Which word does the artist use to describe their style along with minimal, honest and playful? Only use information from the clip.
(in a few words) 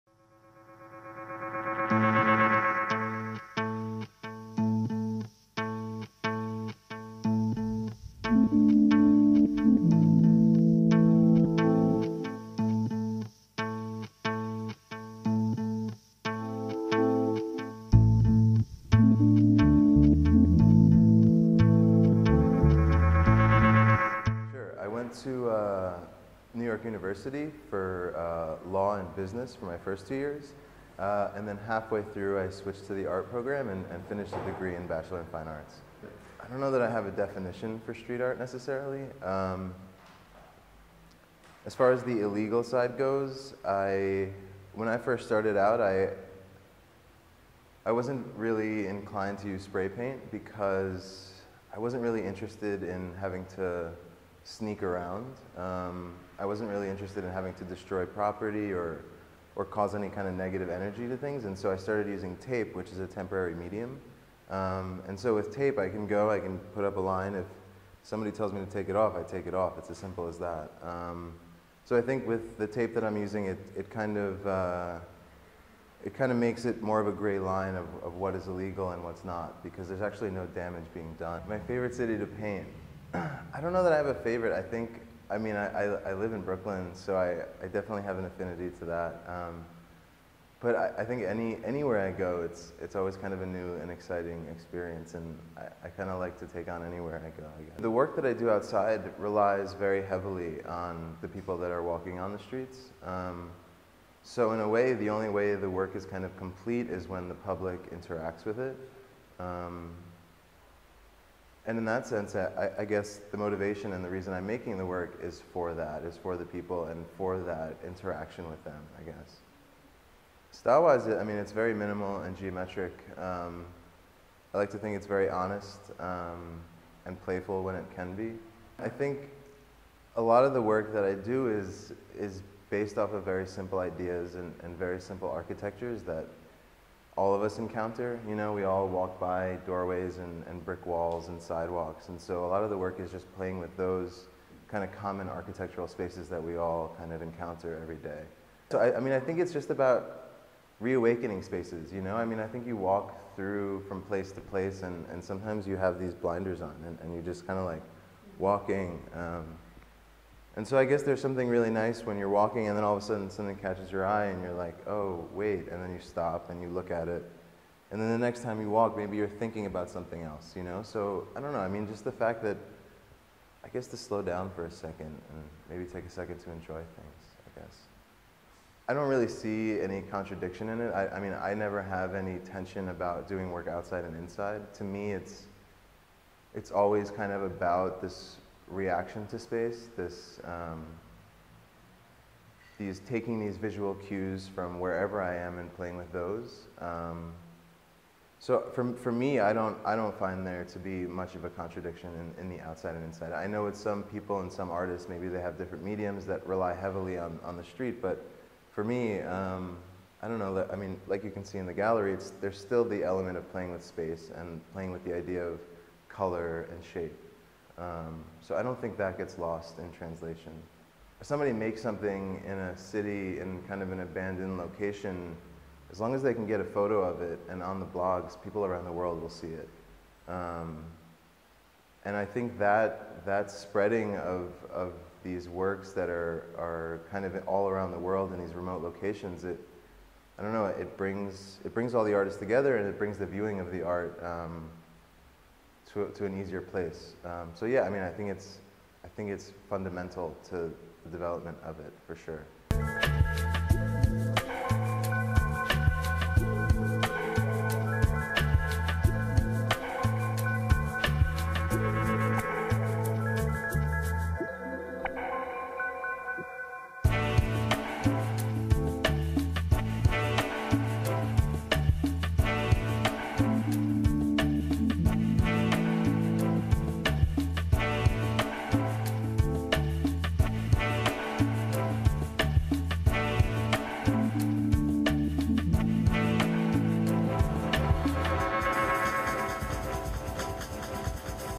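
Geometric.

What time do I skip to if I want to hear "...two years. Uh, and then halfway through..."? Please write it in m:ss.
0:30.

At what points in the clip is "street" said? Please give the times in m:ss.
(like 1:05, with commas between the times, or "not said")
0:37, 1:42, 3:27.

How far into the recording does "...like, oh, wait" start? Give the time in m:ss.
2:44.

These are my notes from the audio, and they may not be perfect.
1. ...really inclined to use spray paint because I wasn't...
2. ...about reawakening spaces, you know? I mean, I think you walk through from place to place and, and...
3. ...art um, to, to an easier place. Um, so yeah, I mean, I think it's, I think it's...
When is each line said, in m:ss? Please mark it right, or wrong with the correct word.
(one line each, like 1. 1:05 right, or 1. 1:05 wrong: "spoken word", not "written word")
1. 0:48 right
2. 2:29 right
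3. 4:03 right.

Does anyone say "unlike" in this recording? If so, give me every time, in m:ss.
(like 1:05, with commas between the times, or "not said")
not said.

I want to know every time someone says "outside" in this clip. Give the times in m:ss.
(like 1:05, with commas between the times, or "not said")
1:38, 3:03, 3:22.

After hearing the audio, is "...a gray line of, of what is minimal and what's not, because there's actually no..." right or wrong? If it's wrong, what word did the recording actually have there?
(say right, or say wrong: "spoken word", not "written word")
wrong: "illegal", not "minimal".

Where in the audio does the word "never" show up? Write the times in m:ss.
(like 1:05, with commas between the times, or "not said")
3:01.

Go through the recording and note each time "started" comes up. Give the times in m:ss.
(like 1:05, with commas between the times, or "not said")
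0:45, 1:01.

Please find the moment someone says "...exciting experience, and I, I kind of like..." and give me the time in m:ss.
1:33.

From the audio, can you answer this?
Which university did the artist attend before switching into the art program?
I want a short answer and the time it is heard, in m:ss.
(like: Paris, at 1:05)
York University, at 0:26.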